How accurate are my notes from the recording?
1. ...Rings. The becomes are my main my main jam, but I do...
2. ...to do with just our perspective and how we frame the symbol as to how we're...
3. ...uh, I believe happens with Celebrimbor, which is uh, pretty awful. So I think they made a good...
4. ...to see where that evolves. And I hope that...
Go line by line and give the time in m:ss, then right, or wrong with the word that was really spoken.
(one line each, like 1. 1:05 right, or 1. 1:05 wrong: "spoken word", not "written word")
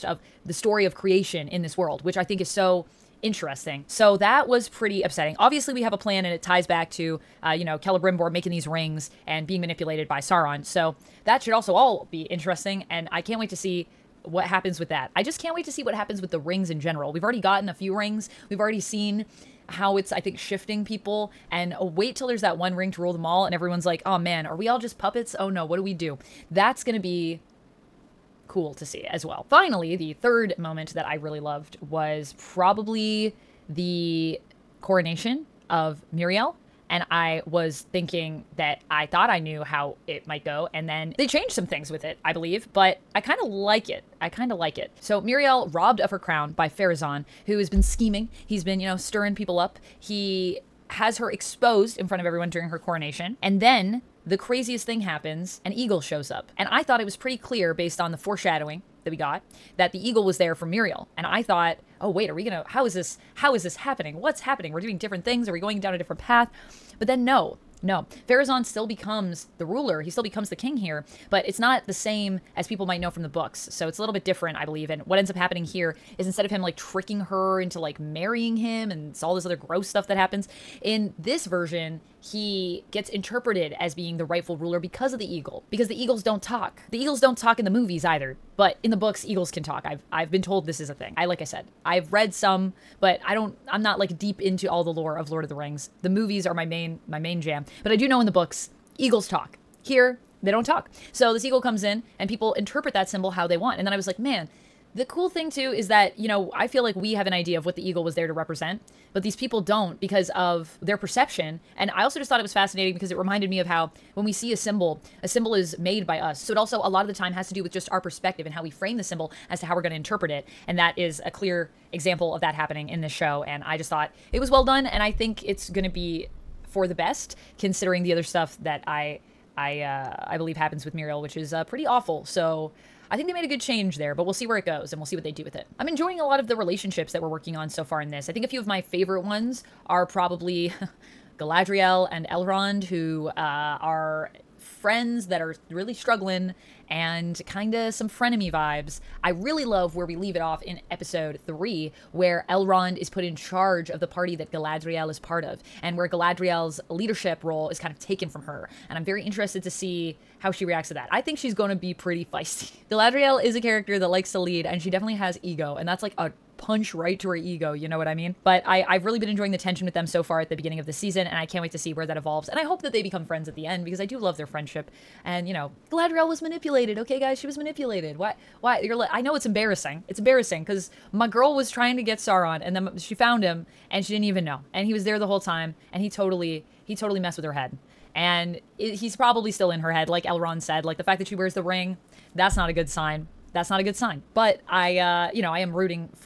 1. 1:35 wrong: "movies", not "becomes"
2. 1:57 right
3. 2:09 wrong: "Míriel", not "Celebrimbor"
4. 2:51 right.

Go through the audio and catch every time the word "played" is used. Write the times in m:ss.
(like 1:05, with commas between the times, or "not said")
not said.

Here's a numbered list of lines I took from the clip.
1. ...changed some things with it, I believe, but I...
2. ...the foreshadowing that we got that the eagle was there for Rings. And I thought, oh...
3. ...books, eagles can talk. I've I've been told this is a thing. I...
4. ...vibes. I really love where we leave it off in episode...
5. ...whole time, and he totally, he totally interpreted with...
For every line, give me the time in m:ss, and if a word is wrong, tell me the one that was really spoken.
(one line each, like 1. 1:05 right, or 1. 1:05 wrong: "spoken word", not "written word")
1. 0:41 right
2. 0:58 wrong: "Míriel", not "Rings"
3. 1:28 right
4. 2:28 right
5. 3:05 wrong: "messed", not "interpreted".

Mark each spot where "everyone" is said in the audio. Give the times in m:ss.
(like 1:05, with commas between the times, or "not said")
0:23, 0:52.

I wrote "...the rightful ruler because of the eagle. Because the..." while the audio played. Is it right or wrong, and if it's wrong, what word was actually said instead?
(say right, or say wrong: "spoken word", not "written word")
right.